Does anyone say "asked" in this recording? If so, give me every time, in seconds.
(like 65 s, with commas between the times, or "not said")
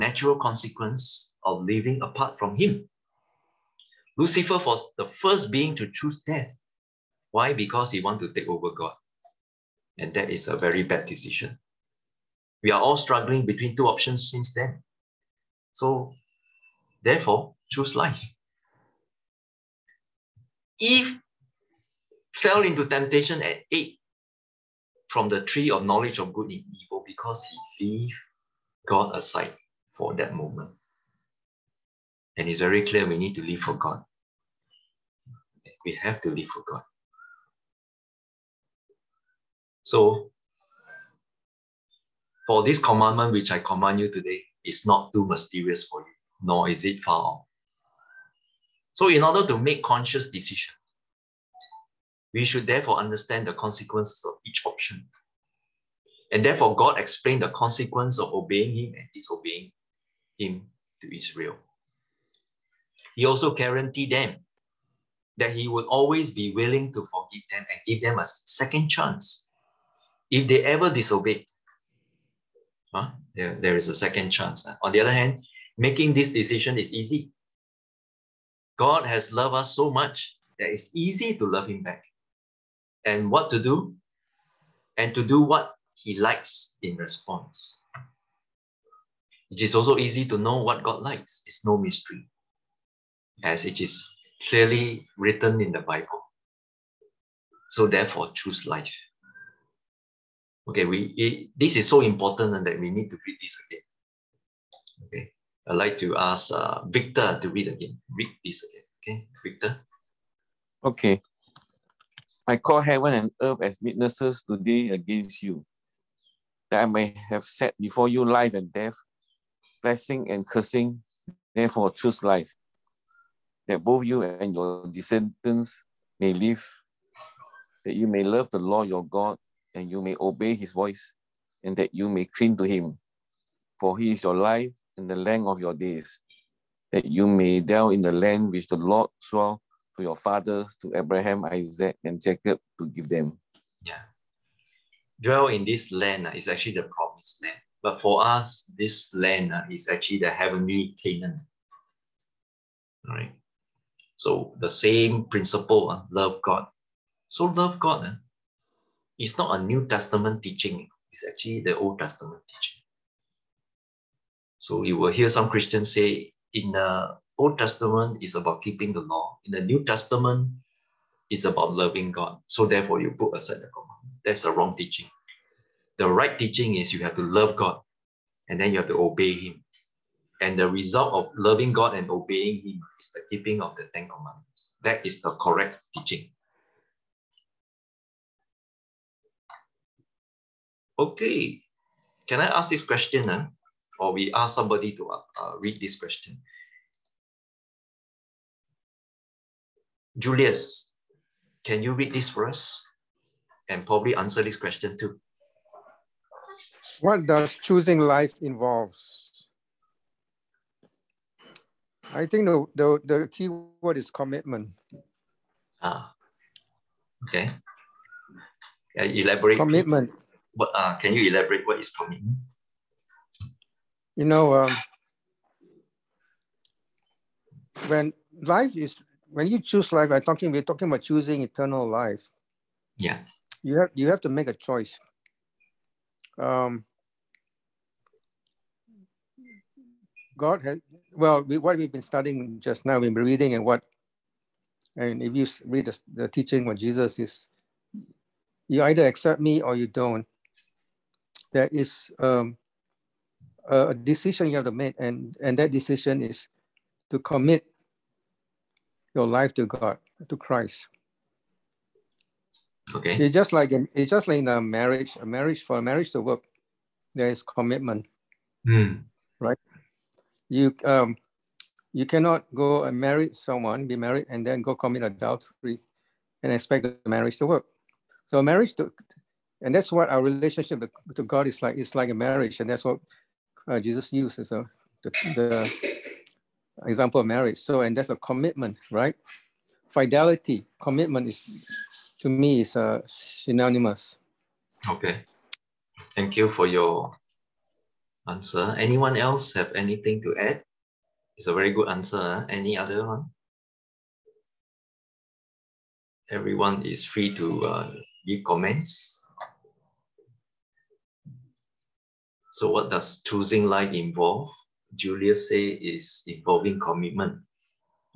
not said.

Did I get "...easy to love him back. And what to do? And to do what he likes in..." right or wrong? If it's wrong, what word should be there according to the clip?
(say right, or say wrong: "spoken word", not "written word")
right.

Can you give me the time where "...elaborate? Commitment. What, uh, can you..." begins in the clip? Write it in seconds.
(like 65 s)
219 s.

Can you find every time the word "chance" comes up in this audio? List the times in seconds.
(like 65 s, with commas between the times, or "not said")
68 s, 74 s.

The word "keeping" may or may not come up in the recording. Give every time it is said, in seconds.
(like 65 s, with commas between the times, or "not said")
168 s, 183 s.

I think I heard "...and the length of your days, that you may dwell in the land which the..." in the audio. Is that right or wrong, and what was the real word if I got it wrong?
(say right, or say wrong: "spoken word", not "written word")
right.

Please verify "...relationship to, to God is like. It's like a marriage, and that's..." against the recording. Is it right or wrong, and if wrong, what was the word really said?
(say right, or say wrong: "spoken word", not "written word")
right.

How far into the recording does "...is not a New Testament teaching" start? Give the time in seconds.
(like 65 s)
159 s.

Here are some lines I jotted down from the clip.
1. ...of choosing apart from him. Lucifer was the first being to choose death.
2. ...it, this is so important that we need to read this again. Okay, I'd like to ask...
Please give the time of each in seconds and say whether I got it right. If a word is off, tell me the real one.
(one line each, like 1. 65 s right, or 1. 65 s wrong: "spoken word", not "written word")
1. 1 s wrong: "living", not "choosing"
2. 101 s right.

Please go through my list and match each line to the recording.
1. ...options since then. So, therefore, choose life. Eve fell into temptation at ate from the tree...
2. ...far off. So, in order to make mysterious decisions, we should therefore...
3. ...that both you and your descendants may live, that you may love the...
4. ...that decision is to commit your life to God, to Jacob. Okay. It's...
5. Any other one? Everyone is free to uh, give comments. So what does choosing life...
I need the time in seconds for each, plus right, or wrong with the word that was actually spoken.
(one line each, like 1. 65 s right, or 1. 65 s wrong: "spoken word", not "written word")
1. 13 s right
2. 47 s wrong: "conscious", not "mysterious"
3. 123 s right
4. 255 s wrong: "Christ", not "Jacob"
5. 302 s right.